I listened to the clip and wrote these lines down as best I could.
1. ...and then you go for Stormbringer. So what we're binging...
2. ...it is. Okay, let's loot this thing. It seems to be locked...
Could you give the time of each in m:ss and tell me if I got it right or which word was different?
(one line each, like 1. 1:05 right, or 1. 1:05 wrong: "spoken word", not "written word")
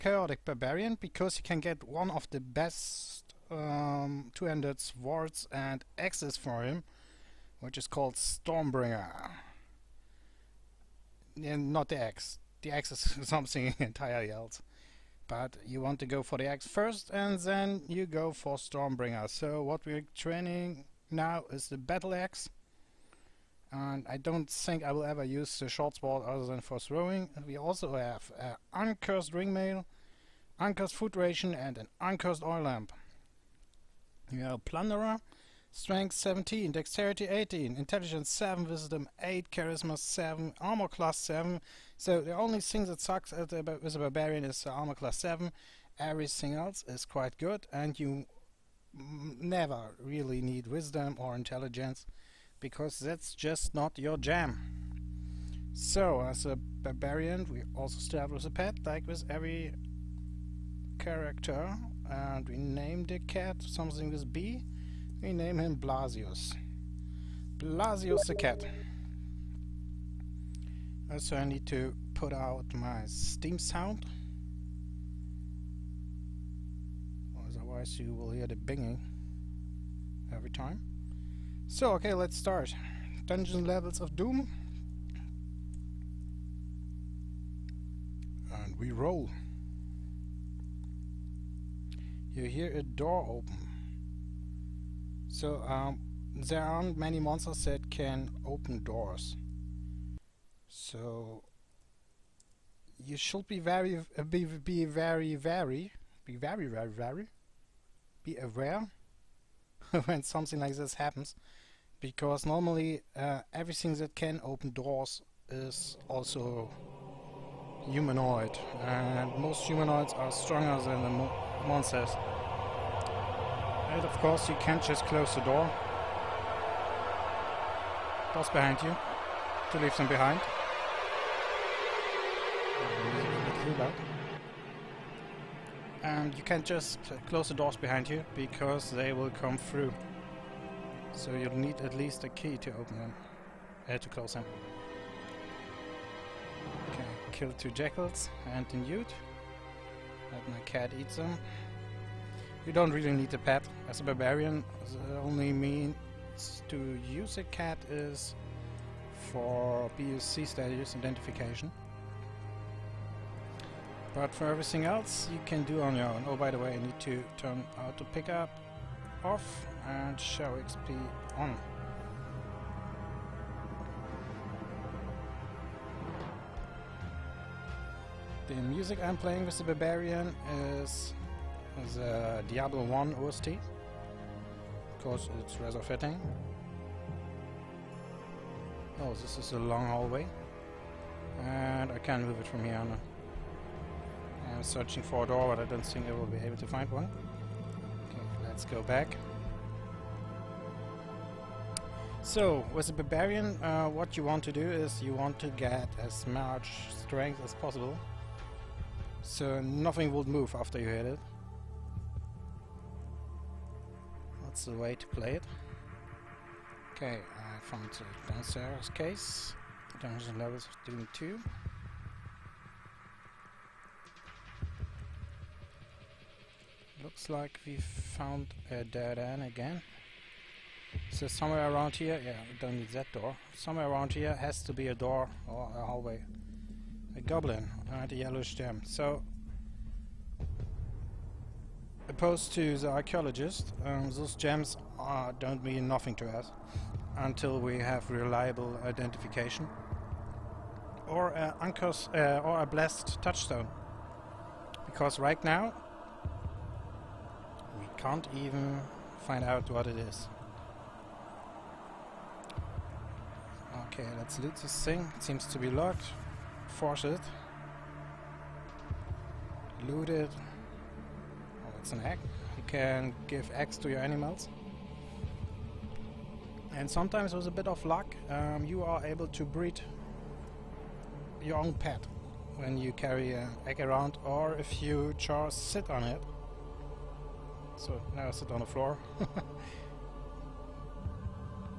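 1. 0:17 wrong: "training", not "binging"
2. 4:19 right.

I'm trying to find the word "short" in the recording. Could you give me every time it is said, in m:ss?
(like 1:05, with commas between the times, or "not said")
0:25.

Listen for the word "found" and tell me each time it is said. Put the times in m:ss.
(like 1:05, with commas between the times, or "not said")
3:37, 3:47.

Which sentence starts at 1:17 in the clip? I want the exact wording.
Otherwise you will hear the binging every time.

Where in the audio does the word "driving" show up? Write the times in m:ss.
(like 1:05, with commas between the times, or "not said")
not said.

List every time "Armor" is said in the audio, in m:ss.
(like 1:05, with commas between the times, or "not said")
0:40, 0:44.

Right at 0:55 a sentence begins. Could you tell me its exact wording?
So as a Barbarian we also start with a pet like with every character and we name the cat something with B.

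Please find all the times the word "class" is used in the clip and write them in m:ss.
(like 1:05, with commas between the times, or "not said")
0:40, 0:44.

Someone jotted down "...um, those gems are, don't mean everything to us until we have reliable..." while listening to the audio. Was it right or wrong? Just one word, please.
wrong.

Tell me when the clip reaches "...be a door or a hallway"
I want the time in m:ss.
3:54.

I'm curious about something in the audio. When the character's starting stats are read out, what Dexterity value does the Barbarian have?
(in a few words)
18.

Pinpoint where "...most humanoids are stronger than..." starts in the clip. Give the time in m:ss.
1:59.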